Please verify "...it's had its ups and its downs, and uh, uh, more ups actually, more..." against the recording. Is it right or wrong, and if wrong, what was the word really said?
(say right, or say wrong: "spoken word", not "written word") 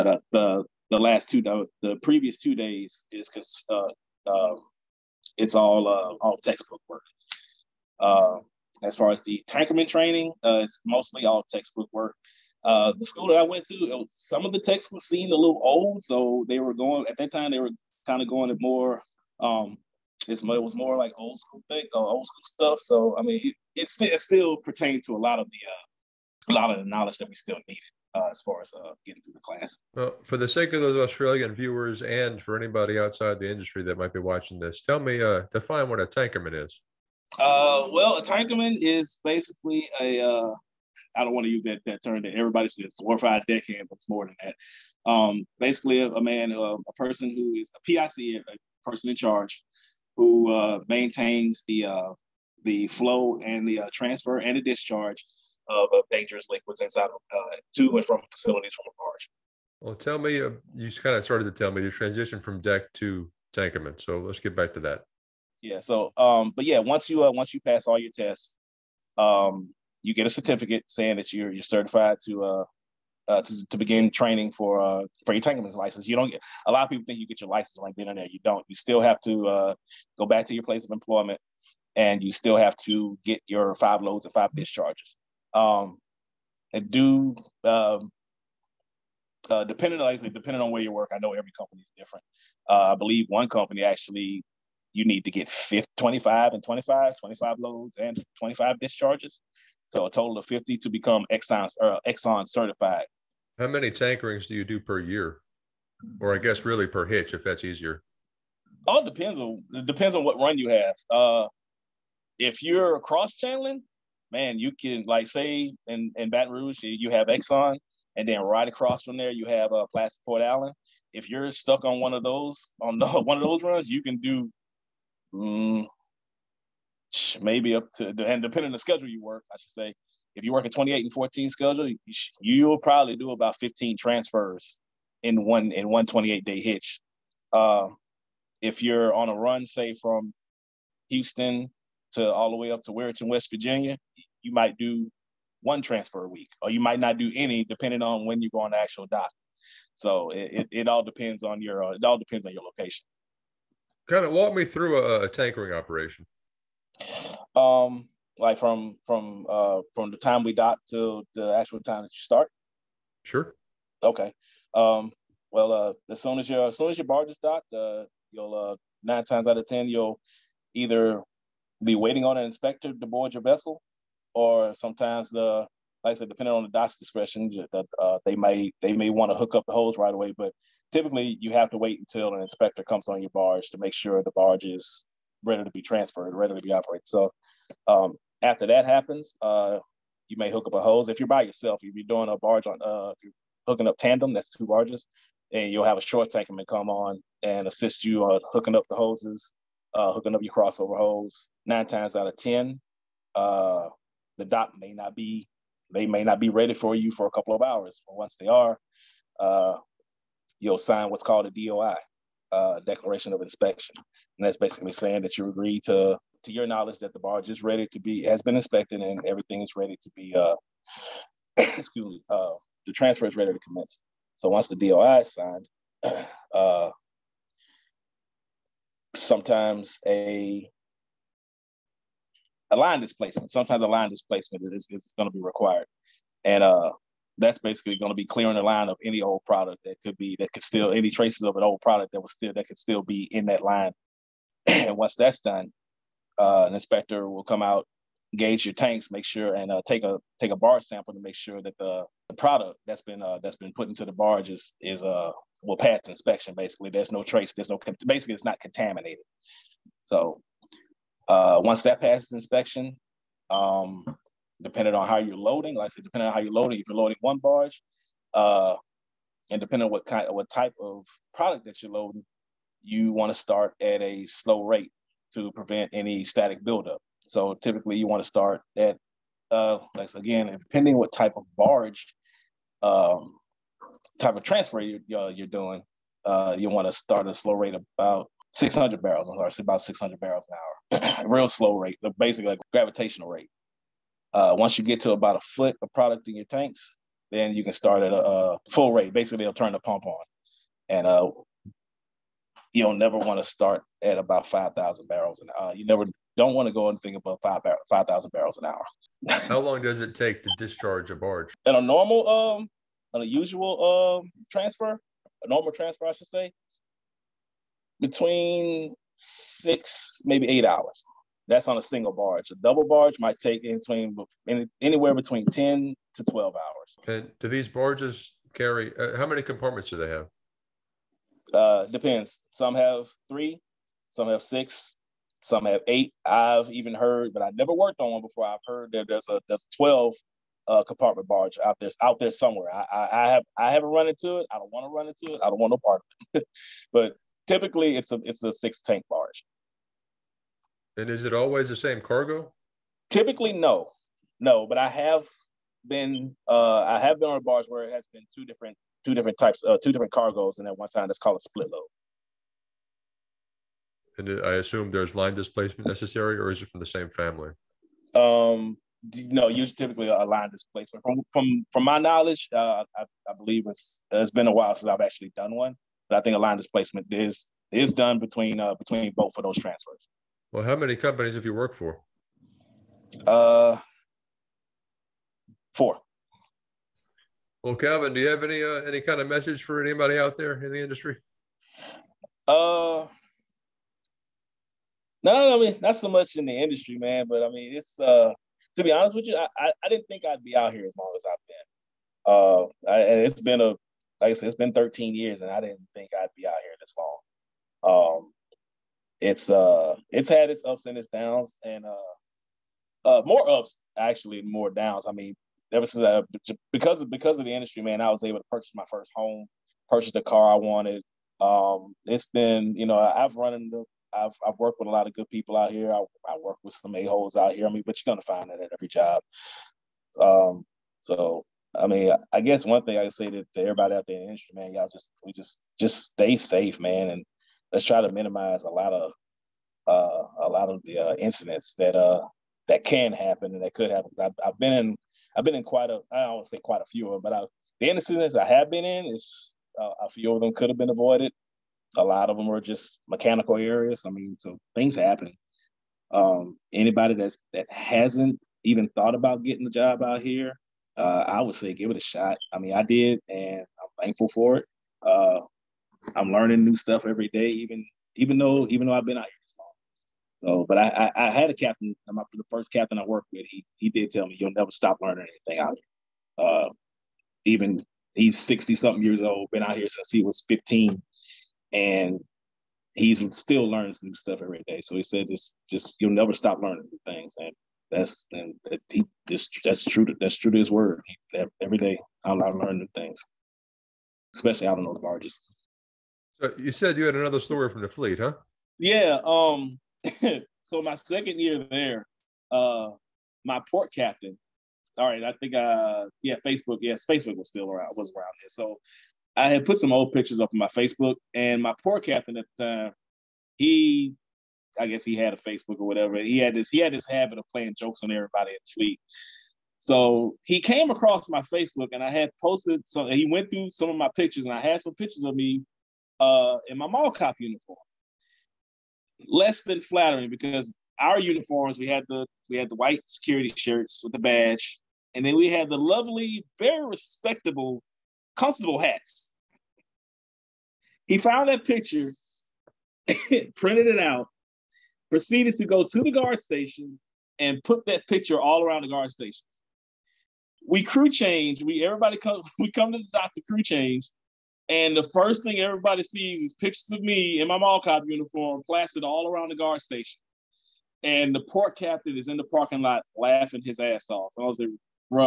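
right.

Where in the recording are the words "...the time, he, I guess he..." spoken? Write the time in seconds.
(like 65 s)
512 s.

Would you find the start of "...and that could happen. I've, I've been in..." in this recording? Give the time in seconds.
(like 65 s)
443 s.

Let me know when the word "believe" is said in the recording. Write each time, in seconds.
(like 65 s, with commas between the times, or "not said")
92 s, 373 s.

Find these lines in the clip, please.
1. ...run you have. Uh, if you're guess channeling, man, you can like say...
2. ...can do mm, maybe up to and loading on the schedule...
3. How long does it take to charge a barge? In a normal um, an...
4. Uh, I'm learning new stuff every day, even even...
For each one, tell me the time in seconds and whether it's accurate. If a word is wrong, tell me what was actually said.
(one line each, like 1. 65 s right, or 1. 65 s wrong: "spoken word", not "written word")
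1. 110 s wrong: "cross", not "guess"
2. 124 s wrong: "depending", not "loading"
3. 309 s wrong: "discharge", not "charge"
4. 465 s right.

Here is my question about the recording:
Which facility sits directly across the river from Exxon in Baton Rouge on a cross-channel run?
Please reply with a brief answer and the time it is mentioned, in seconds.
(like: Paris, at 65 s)
Placid Port Allen, at 119 s.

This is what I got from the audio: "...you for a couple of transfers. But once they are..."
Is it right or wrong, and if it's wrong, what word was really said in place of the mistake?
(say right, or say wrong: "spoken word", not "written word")
wrong: "hours", not "transfers".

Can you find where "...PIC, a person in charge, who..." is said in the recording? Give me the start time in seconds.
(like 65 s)
47 s.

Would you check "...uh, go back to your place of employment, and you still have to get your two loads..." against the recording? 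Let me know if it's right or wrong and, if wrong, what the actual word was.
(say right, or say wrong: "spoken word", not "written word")
wrong: "five", not "two".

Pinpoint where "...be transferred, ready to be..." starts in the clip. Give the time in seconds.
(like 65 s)
185 s.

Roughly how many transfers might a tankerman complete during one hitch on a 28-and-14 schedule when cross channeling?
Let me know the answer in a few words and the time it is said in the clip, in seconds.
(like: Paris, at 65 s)
15, at 133 s.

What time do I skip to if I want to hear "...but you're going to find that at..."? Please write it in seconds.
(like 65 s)
427 s.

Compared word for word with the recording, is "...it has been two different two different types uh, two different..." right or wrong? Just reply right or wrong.
right.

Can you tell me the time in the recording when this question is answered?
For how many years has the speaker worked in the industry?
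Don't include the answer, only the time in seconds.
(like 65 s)
404 s.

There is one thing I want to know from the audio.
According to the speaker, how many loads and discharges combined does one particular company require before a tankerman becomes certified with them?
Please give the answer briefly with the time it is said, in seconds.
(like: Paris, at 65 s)
50, at 99 s.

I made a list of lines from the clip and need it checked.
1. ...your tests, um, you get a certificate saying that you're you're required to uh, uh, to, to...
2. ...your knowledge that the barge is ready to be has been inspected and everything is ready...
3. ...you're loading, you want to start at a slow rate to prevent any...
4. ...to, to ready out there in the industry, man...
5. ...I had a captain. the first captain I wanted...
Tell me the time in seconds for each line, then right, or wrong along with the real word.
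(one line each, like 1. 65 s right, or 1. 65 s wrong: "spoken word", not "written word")
1. 67 s wrong: "certified", not "required"
2. 216 s right
3. 271 s right
4. 433 s wrong: "everybody", not "ready"
5. 471 s wrong: "worked", not "wanted".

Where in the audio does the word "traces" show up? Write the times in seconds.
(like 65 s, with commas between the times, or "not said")
241 s, 257 s.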